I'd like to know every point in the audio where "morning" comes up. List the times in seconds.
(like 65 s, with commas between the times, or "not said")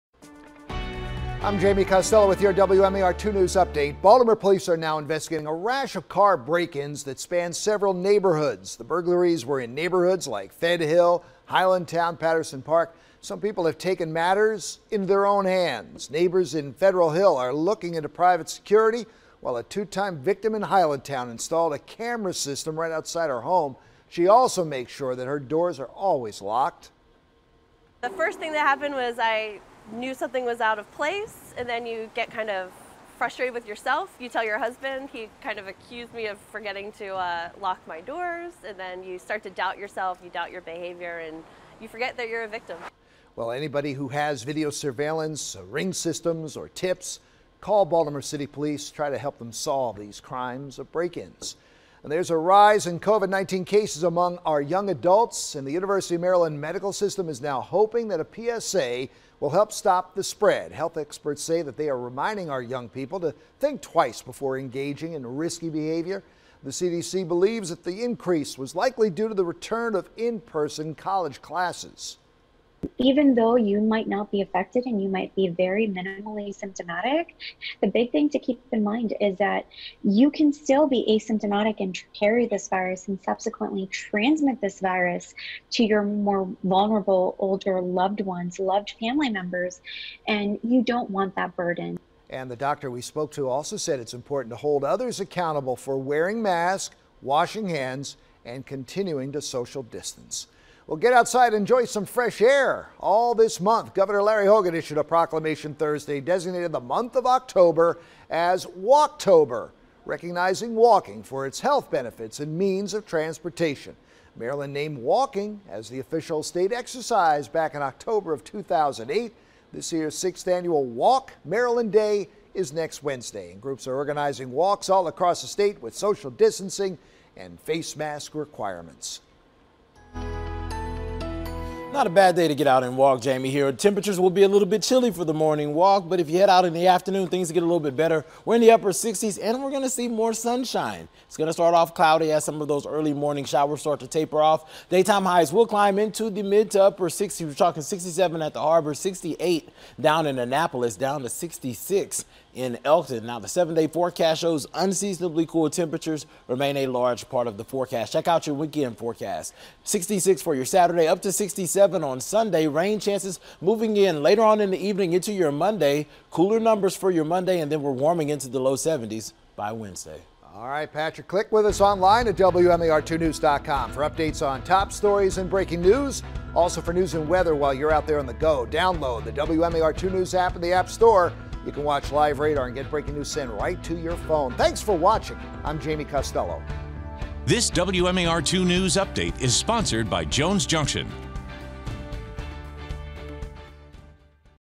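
135 s, 143 s.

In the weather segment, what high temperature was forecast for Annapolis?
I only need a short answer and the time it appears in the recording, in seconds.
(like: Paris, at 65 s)
68, at 148 s.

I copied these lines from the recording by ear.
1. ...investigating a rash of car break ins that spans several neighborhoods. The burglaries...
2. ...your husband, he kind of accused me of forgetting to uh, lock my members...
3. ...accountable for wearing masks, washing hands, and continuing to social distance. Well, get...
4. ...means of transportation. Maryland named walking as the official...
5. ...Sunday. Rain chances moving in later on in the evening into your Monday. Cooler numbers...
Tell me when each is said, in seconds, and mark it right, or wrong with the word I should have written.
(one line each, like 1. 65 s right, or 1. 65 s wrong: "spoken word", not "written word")
1. 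4 s right
2. 34 s wrong: "doors", not "members"
3. 95 s right
4. 112 s right
5. 162 s right.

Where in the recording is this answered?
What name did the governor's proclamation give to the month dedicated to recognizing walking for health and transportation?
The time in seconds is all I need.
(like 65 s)
108 s.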